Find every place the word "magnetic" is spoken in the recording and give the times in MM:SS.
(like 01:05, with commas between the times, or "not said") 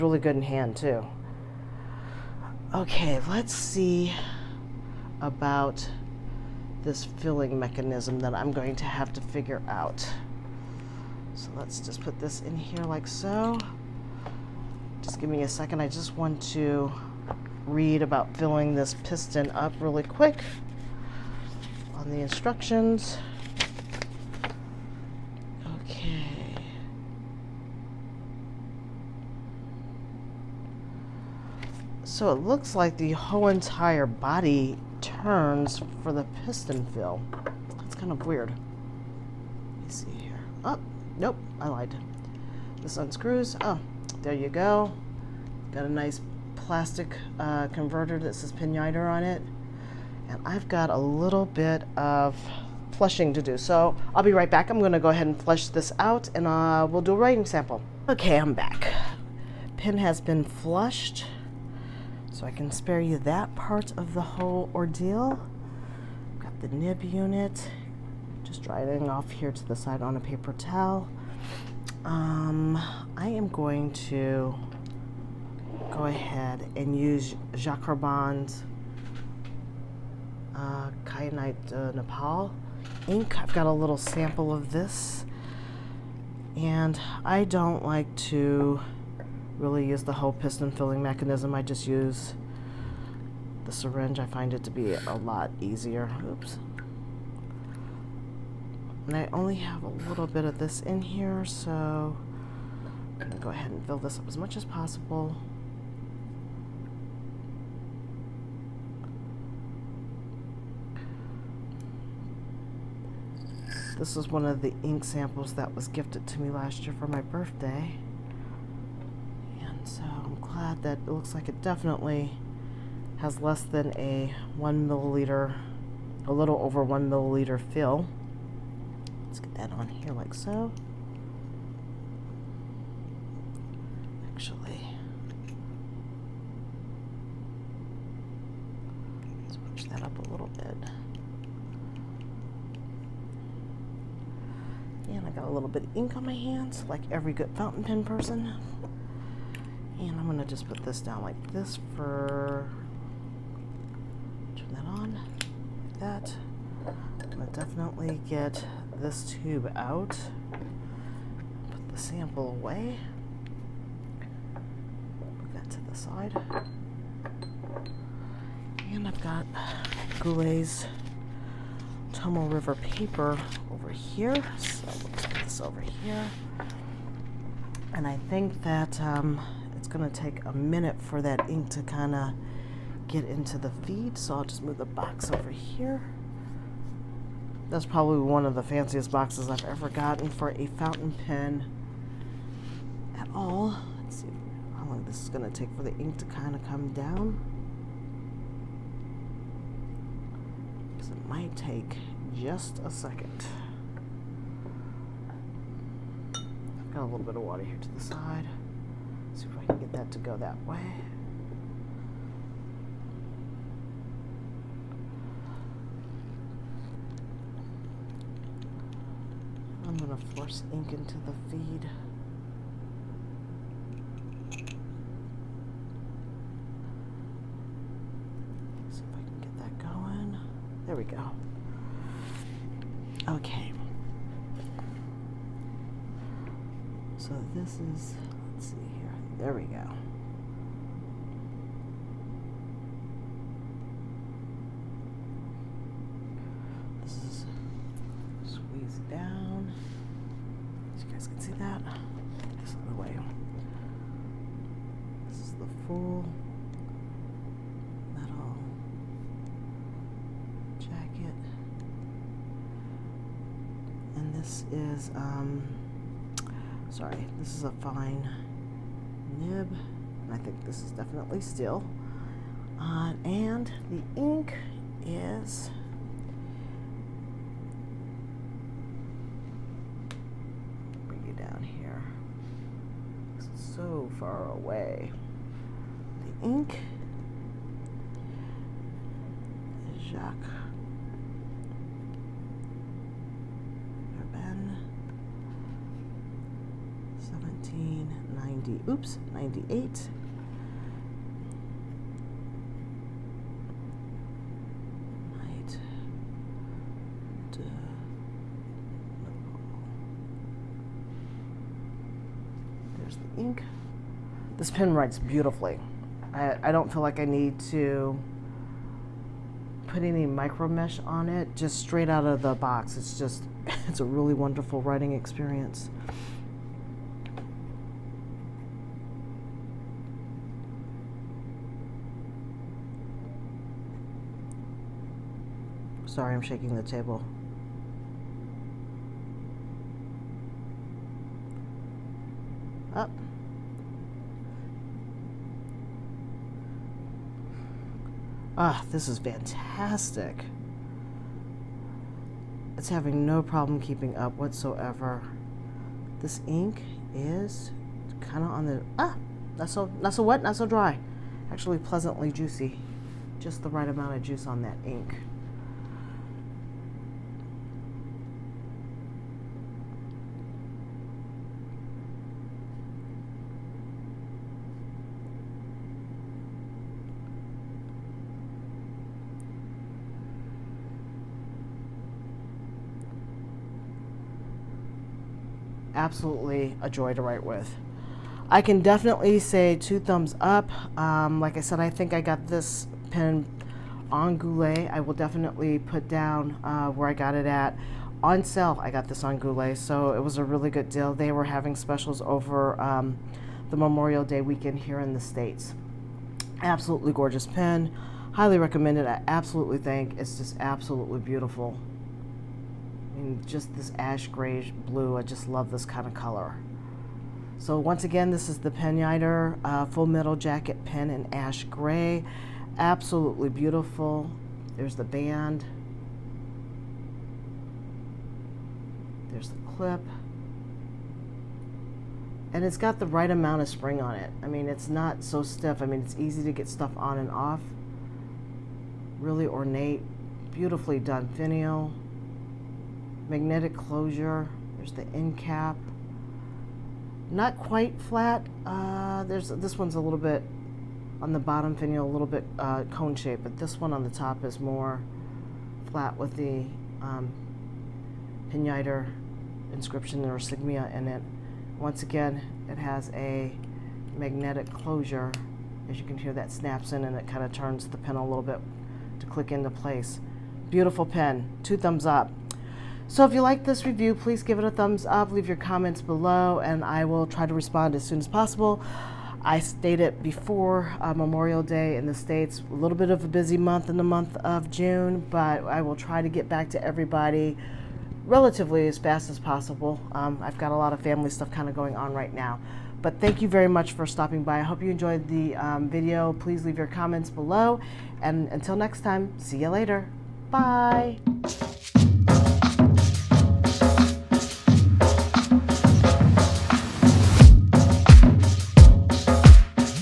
07:23, 07:44.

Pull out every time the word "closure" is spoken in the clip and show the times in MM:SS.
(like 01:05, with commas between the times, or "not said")
07:23, 07:44.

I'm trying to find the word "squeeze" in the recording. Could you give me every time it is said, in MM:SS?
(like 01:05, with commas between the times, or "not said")
04:08.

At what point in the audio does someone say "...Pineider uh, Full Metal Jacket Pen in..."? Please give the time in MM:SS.
06:58.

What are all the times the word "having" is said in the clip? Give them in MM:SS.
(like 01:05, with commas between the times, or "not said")
05:52, 06:41.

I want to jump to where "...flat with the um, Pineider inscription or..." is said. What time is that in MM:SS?
07:35.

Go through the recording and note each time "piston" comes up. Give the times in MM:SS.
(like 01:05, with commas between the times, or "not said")
00:19, 00:36, 01:30.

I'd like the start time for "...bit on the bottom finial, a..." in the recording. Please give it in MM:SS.
07:30.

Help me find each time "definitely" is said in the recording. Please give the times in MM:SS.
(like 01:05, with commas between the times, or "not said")
02:01, 02:37, 04:30, 06:28, 06:35.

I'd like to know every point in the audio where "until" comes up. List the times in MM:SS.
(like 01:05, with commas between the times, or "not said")
08:18.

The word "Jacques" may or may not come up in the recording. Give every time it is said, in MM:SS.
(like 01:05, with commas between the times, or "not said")
01:17, 04:50.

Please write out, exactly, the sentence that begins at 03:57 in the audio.
So this is, let's see here.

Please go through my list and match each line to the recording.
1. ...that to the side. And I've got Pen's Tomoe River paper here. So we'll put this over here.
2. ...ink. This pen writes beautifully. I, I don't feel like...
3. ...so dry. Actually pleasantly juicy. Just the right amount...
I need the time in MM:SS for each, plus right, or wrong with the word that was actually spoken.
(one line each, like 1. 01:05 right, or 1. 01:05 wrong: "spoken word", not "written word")
1. 02:45 wrong: "Goulet", not "Pen"
2. 05:13 right
3. 06:00 right.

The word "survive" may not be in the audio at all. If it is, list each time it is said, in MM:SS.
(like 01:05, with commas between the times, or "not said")
not said.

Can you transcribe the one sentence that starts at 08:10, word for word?
Um, I've got a lot of family stuff kind of going on right now.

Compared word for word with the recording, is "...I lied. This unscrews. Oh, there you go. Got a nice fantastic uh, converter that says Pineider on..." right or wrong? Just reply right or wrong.
wrong.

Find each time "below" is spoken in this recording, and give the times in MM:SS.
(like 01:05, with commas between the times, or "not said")
07:56, 08:17.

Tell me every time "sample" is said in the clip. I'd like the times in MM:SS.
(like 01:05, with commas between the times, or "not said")
00:57, 01:23, 01:55, 02:41.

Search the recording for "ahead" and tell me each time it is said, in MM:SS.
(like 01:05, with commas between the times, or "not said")
00:55, 01:16, 01:43.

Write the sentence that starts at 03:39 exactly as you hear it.
I'm gonna force ink into the feed.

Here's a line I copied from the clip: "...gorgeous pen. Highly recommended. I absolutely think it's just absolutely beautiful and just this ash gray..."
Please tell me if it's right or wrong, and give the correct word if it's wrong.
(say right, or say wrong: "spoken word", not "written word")
right.